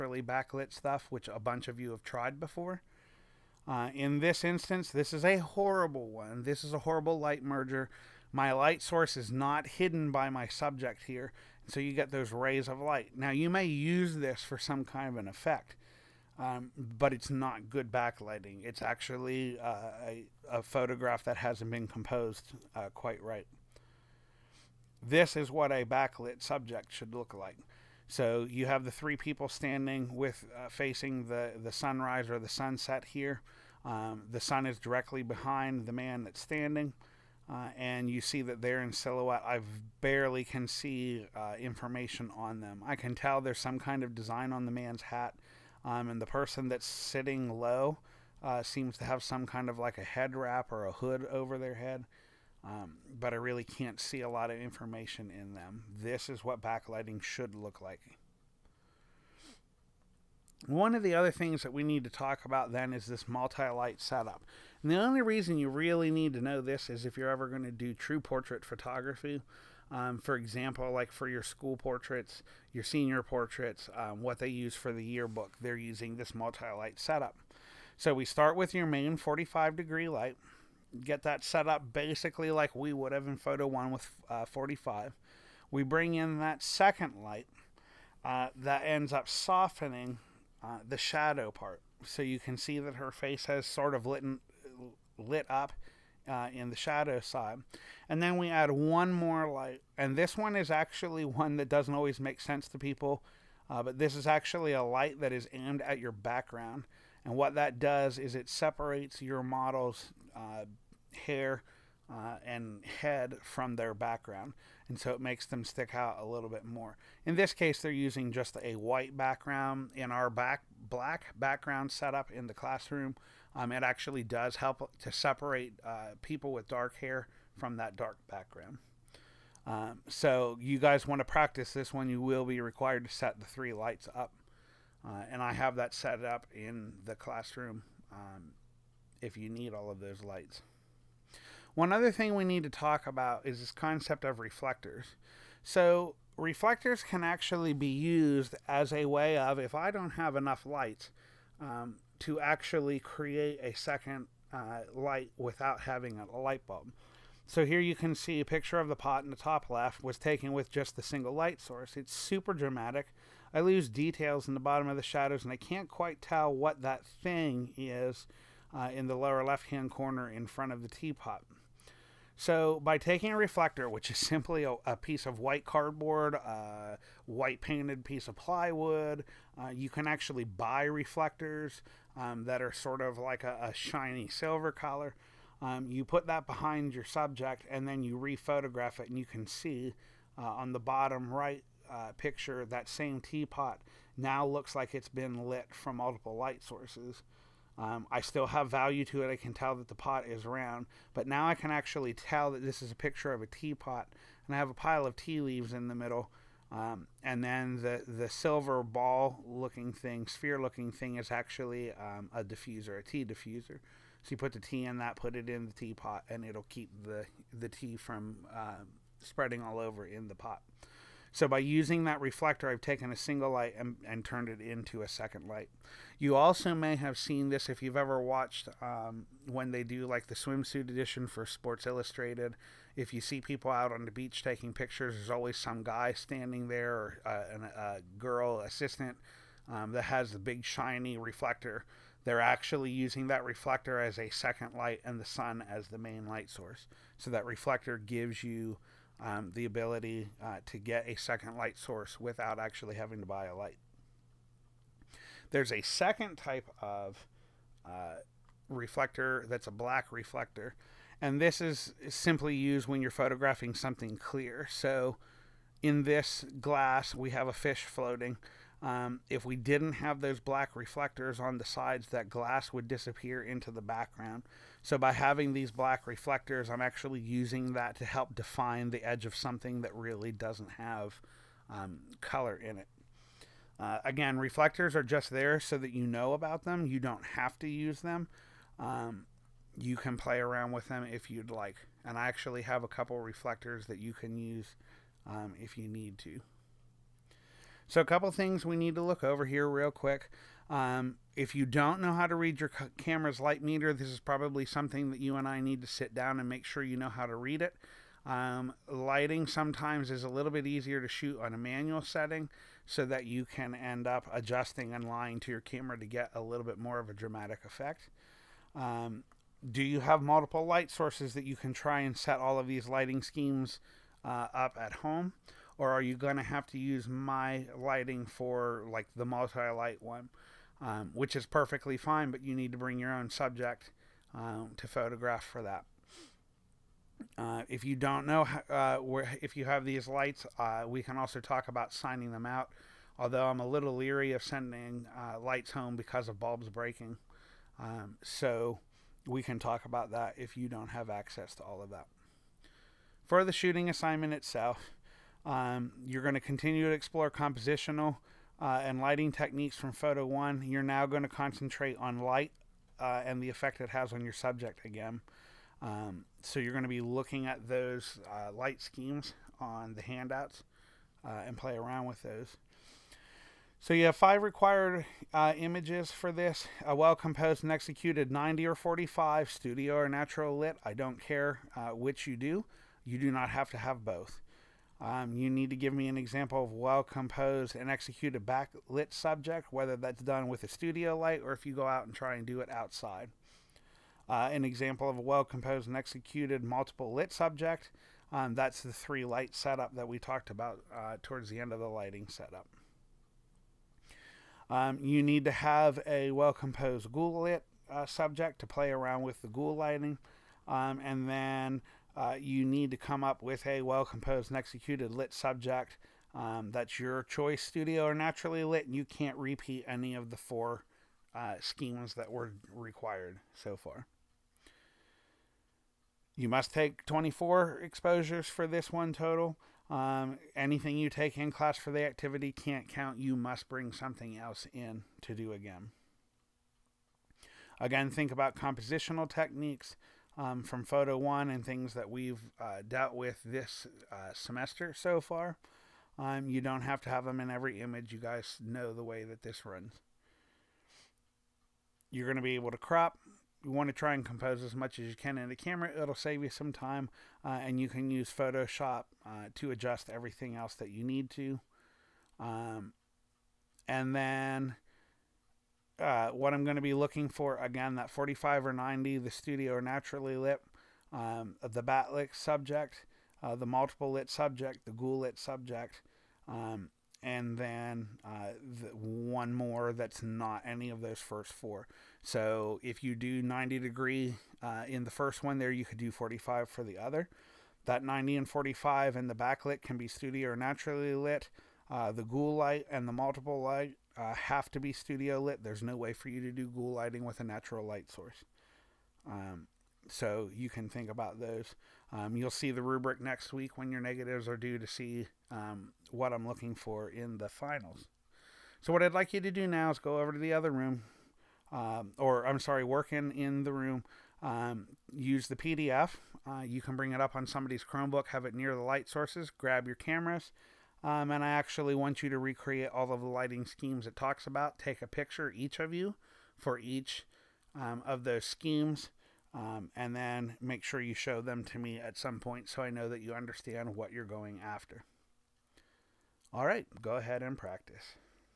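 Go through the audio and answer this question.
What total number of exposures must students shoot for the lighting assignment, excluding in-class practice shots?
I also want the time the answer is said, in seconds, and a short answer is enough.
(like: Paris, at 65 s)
24, at 427 s.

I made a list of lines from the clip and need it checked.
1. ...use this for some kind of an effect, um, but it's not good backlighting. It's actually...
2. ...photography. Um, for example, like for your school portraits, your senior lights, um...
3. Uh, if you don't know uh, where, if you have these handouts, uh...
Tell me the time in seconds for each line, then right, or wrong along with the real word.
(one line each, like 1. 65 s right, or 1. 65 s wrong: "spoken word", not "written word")
1. 13 s right
2. 68 s wrong: "portraits", not "lights"
3. 337 s wrong: "lights", not "handouts".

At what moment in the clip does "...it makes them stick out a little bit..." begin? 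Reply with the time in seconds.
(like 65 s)
115 s.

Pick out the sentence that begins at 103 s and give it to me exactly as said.
Uh, but this is actually a light that is aimed at your background.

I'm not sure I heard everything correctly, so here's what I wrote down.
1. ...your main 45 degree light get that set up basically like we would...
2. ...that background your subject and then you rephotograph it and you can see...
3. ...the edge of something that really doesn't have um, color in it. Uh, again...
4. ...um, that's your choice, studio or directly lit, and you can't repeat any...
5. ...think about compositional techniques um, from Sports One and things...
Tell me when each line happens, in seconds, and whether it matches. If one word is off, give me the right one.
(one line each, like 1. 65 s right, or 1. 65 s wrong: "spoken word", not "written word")
1. 78 s right
2. 186 s wrong: "behind", not "background"
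3. 278 s right
4. 416 s wrong: "naturally", not "directly"
5. 438 s wrong: "Photo", not "Sports".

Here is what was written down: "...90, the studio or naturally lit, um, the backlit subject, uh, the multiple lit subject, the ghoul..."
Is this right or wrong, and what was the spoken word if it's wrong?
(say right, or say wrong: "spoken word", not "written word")
right.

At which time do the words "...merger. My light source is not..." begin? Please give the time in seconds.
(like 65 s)
7 s.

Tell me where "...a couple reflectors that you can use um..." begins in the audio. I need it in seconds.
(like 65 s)
292 s.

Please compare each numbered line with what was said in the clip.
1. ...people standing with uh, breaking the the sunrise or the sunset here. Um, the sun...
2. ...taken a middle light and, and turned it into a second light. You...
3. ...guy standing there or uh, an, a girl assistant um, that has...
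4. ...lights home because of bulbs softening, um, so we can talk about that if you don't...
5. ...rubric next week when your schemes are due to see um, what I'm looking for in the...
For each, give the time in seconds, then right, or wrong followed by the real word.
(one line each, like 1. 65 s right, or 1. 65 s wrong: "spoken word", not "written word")
1. 29 s wrong: "facing", not "breaking"
2. 222 s wrong: "single", not "middle"
3. 235 s right
4. 345 s wrong: "breaking", not "softening"
5. 502 s wrong: "negatives", not "schemes".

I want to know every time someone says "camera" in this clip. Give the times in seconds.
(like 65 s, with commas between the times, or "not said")
302 s, 315 s, 455 s, 519 s.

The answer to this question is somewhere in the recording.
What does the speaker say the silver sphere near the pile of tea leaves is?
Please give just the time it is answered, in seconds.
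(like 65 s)
212 s.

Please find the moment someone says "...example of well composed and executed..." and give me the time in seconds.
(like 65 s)
386 s.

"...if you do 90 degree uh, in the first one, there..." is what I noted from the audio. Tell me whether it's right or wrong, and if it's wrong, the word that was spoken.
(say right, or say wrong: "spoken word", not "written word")
right.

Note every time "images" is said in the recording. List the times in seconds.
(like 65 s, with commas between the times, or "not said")
375 s, 447 s.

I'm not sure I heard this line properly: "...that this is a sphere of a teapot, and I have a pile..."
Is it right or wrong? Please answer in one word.
wrong.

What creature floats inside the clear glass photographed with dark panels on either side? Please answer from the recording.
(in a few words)
a fish.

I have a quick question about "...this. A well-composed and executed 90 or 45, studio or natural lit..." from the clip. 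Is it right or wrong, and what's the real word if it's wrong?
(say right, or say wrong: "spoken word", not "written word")
right.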